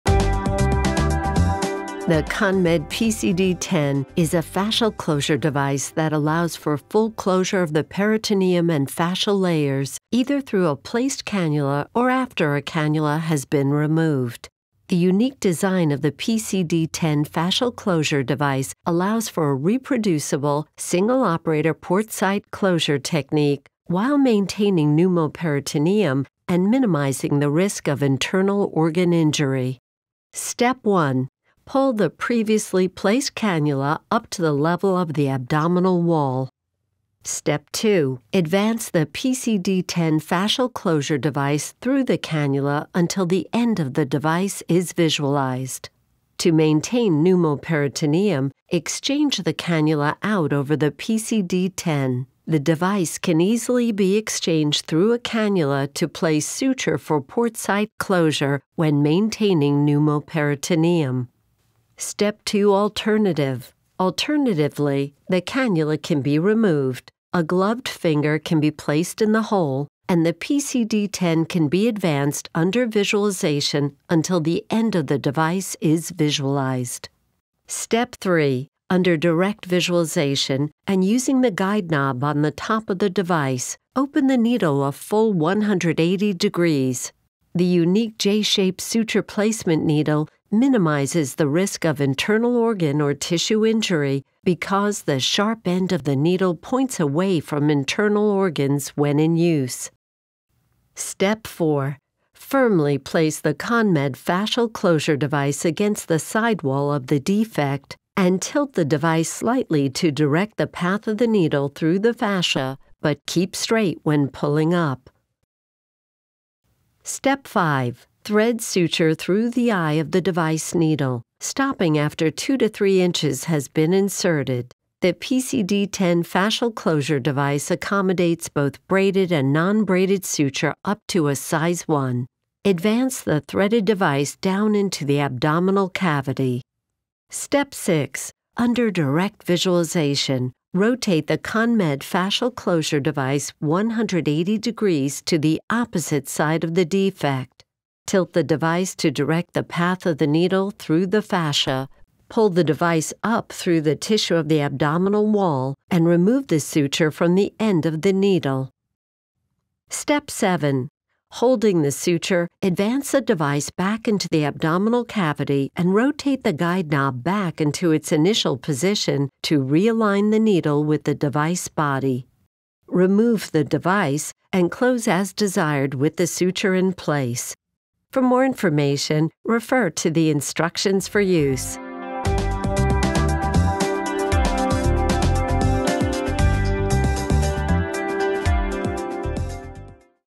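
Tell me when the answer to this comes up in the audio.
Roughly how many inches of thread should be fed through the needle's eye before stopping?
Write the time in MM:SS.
02:02.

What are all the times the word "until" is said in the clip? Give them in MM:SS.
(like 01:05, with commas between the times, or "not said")
00:42, 01:14.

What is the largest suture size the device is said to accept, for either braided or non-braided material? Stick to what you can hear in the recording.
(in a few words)
Size 1.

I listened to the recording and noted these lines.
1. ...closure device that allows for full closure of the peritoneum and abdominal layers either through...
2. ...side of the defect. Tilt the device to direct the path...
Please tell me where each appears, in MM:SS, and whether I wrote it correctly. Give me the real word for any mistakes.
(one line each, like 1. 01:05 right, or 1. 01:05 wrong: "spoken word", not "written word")
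1. 00:04 wrong: "fascial", not "abdominal"
2. 02:26 right.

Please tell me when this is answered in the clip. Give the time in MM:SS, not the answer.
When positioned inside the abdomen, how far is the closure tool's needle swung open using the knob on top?
01:24.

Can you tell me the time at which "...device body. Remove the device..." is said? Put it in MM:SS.
02:51.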